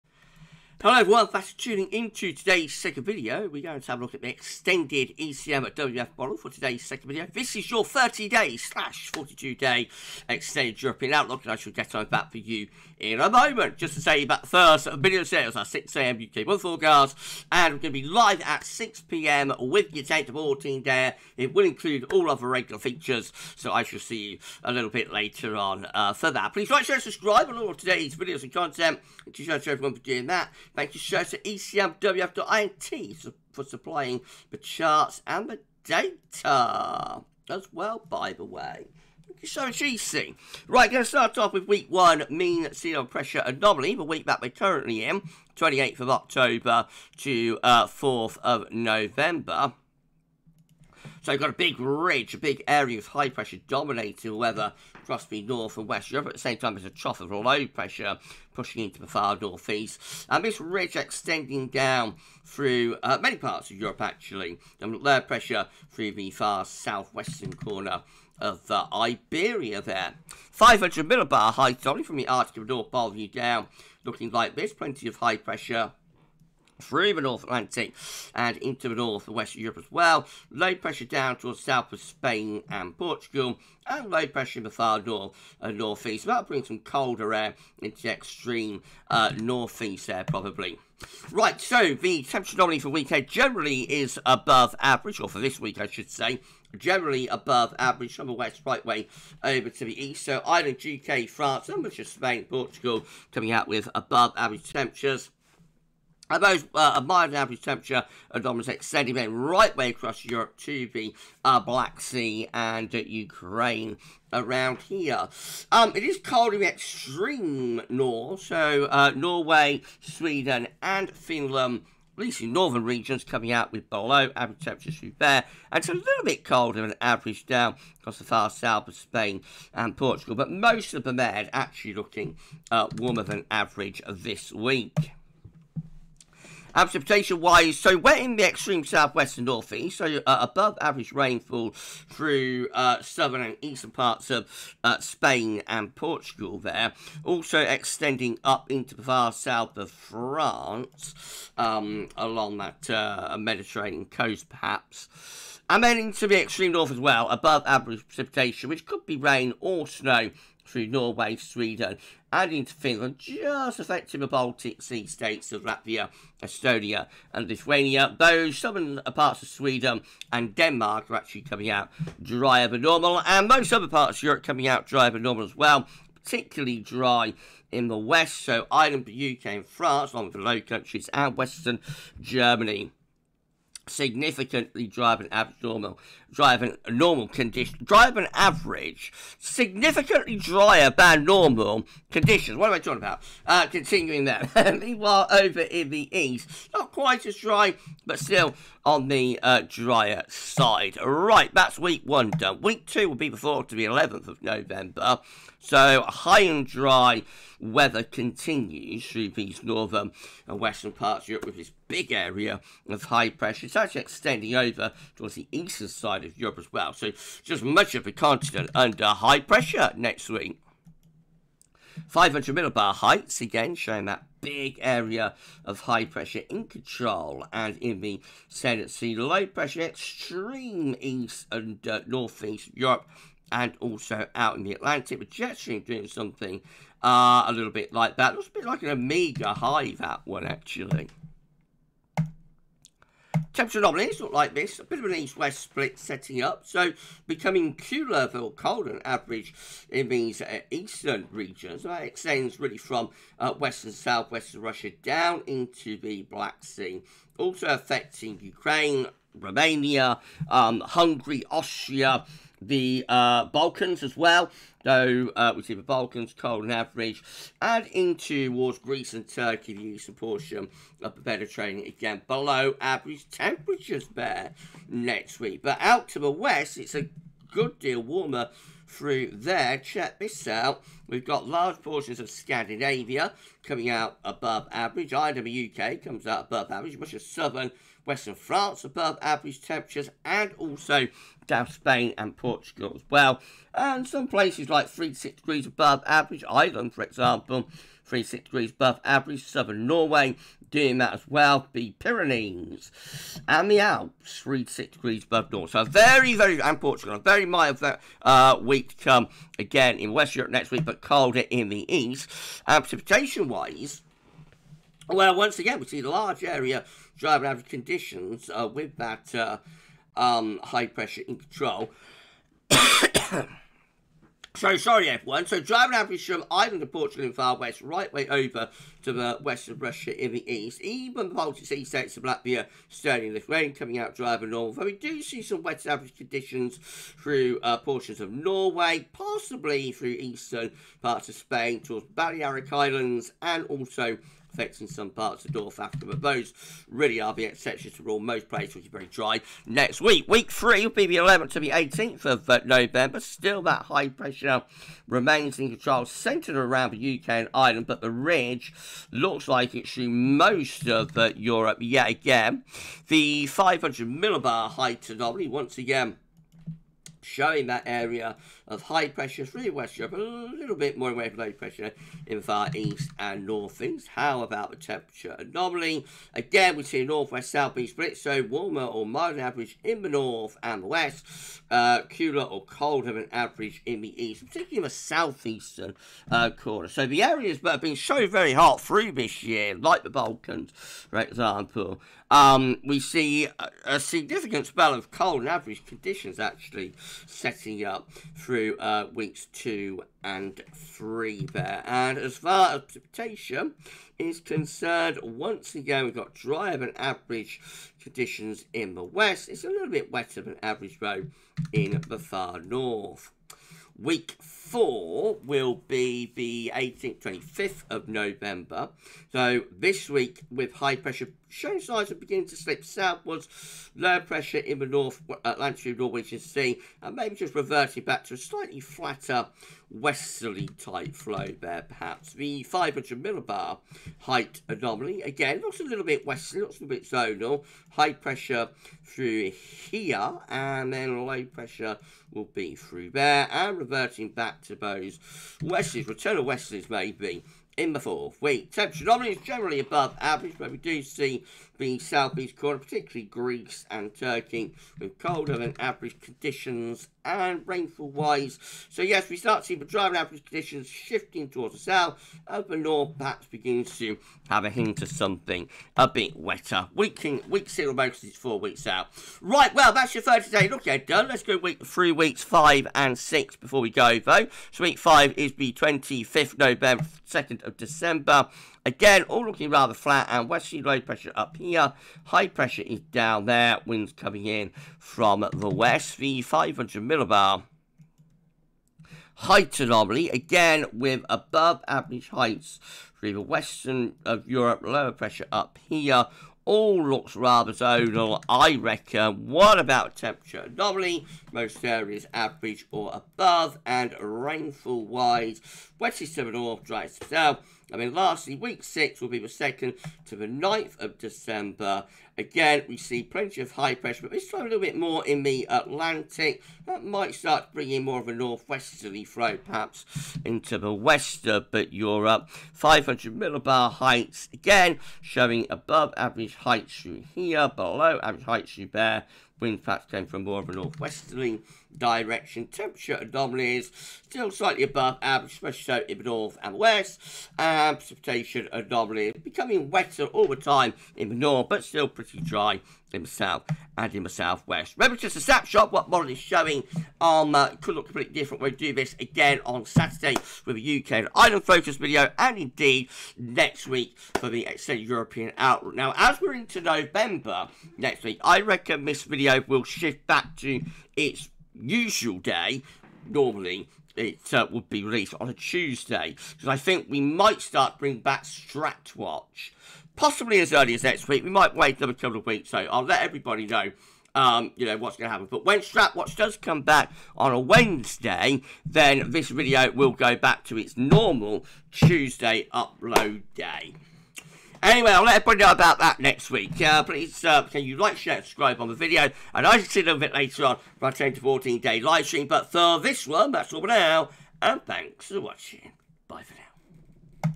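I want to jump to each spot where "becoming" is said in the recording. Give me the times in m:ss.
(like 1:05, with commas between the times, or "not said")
4:07, 8:59.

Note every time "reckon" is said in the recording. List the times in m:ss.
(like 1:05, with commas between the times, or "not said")
8:18, 9:18.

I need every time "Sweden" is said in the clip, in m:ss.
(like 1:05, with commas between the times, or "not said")
1:59, 2:41, 2:49.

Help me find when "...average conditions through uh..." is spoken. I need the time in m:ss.
5:35.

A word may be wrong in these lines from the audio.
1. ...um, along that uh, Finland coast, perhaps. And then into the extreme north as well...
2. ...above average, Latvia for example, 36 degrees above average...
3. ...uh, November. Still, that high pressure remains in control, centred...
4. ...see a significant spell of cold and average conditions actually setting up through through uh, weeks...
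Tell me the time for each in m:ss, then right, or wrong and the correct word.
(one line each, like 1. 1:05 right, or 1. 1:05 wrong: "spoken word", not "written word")
1. 2:31 wrong: "Mediterranean", not "Finland"
2. 4:55 wrong: "Ireland", not "Latvia"
3. 5:52 right
4. 6:33 right.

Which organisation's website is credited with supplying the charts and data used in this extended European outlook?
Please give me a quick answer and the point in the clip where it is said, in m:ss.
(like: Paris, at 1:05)
ECMWF.int, at 0:31.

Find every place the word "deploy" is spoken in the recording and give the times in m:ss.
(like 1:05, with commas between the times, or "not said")
not said.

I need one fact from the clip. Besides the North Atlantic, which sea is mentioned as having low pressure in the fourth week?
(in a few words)
Norwegian Sea.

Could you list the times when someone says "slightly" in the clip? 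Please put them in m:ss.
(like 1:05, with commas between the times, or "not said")
7:08, 8:54.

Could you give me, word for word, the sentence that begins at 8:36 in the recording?
That might start bringing more of a northwesterly flow, perhaps, into the west of Europe.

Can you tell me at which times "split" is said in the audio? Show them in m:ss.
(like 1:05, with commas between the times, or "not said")
4:05, 6:17.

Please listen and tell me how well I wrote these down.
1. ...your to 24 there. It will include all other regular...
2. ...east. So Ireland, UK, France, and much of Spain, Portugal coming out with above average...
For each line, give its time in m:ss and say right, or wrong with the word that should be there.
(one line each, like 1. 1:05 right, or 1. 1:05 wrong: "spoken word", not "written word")
1. 0:19 wrong: "14", not "24"
2. 1:40 right.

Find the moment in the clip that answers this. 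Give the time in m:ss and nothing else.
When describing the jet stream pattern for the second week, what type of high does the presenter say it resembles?
3:58.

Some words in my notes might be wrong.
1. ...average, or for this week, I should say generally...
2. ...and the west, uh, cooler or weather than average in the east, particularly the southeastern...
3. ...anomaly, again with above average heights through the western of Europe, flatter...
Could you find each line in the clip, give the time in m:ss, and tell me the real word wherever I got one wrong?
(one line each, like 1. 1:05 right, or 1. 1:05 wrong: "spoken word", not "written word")
1. 1:34 right
2. 6:20 wrong: "colder", not "weather"
3. 8:09 wrong: "lower", not "flatter".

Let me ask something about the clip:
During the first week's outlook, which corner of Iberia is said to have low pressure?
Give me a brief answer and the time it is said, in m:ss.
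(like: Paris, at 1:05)
far southwestern corner, at 1:06.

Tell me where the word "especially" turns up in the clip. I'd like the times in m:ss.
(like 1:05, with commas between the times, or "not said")
8:55.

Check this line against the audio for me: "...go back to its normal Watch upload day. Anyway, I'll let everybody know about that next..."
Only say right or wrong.
wrong.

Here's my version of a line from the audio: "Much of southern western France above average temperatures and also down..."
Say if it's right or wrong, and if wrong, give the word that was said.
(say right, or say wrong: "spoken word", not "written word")
right.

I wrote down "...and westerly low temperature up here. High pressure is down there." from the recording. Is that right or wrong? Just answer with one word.
wrong.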